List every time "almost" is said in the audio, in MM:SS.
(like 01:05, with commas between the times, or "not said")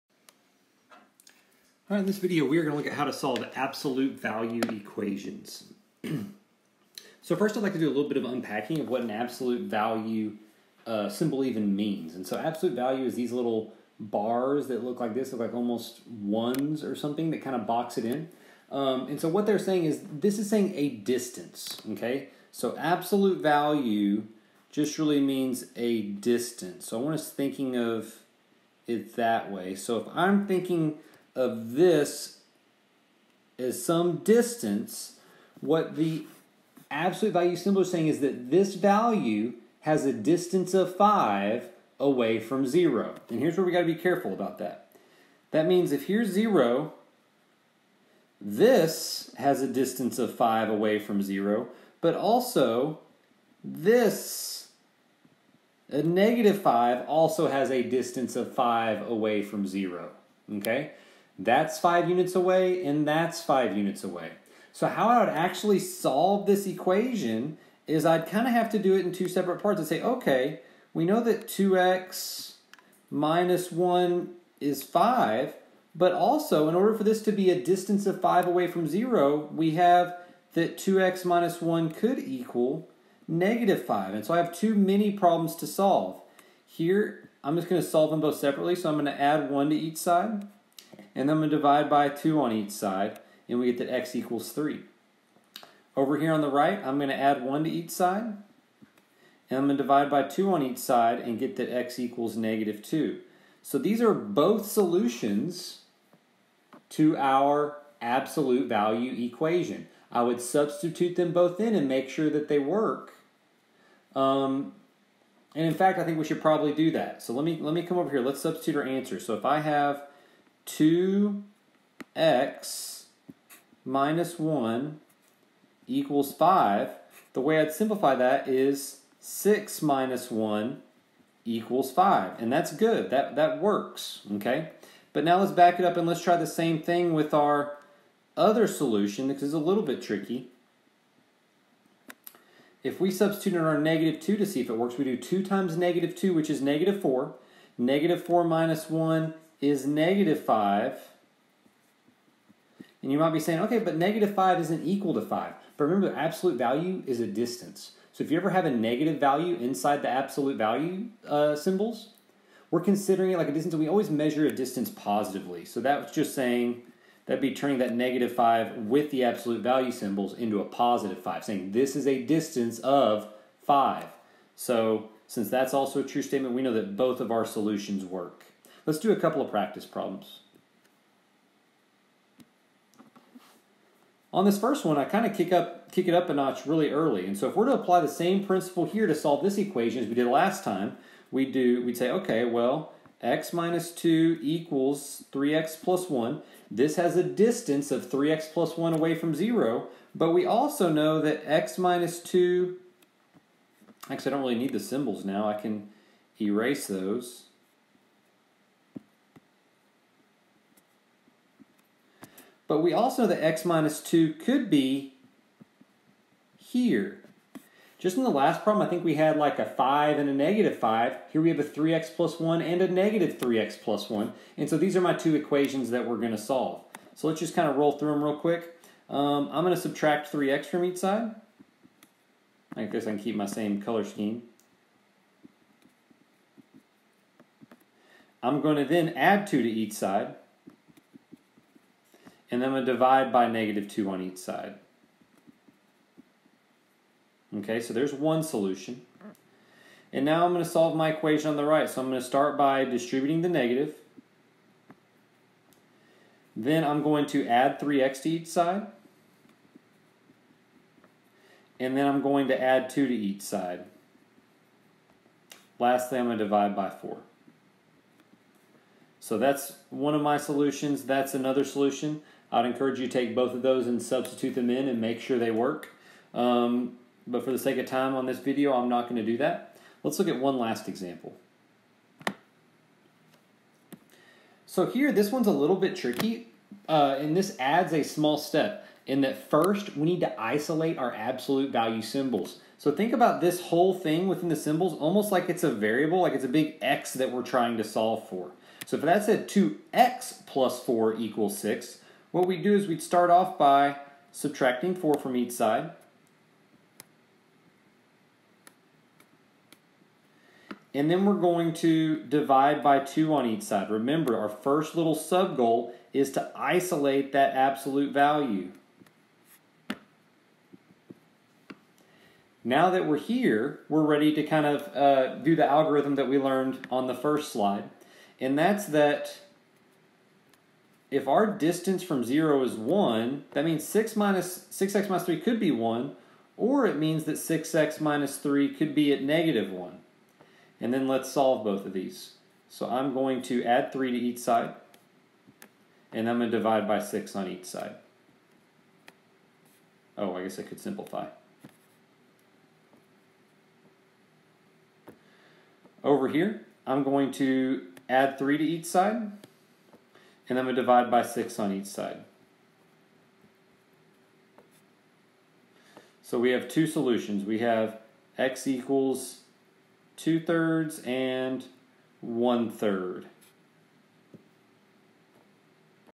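00:15, 04:54.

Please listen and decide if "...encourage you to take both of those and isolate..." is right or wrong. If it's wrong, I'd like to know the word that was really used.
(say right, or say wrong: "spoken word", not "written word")
wrong: "substitute", not "isolate".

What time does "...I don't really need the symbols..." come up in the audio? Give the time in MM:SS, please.
03:24.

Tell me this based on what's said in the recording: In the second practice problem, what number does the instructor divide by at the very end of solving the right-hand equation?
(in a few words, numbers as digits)
4.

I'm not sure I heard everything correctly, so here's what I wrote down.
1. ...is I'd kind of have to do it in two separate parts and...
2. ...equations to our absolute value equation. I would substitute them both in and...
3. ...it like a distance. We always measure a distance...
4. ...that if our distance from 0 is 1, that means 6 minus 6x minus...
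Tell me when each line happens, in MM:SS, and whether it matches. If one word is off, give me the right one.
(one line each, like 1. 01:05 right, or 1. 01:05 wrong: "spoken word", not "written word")
1. 01:07 right
2. 01:44 wrong: "solutions", not "equations"
3. 02:43 right
4. 05:28 right.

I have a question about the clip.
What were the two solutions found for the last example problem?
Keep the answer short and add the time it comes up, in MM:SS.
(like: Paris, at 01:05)
2/3 and 1/3, at 06:10.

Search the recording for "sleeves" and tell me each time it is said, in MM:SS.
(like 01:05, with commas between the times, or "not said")
not said.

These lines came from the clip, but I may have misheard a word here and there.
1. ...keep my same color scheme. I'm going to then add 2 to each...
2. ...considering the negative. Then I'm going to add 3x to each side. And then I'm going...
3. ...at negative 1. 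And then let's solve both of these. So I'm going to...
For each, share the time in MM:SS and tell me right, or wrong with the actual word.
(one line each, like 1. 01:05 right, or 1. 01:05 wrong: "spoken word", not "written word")
1. 03:53 right
2. 04:12 wrong: "distributing", not "considering"
3. 05:39 right.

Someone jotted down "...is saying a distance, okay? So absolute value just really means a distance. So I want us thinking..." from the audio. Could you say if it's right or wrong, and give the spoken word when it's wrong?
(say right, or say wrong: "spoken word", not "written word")
right.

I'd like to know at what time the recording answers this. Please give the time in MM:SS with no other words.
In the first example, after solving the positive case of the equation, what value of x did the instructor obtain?
01:33.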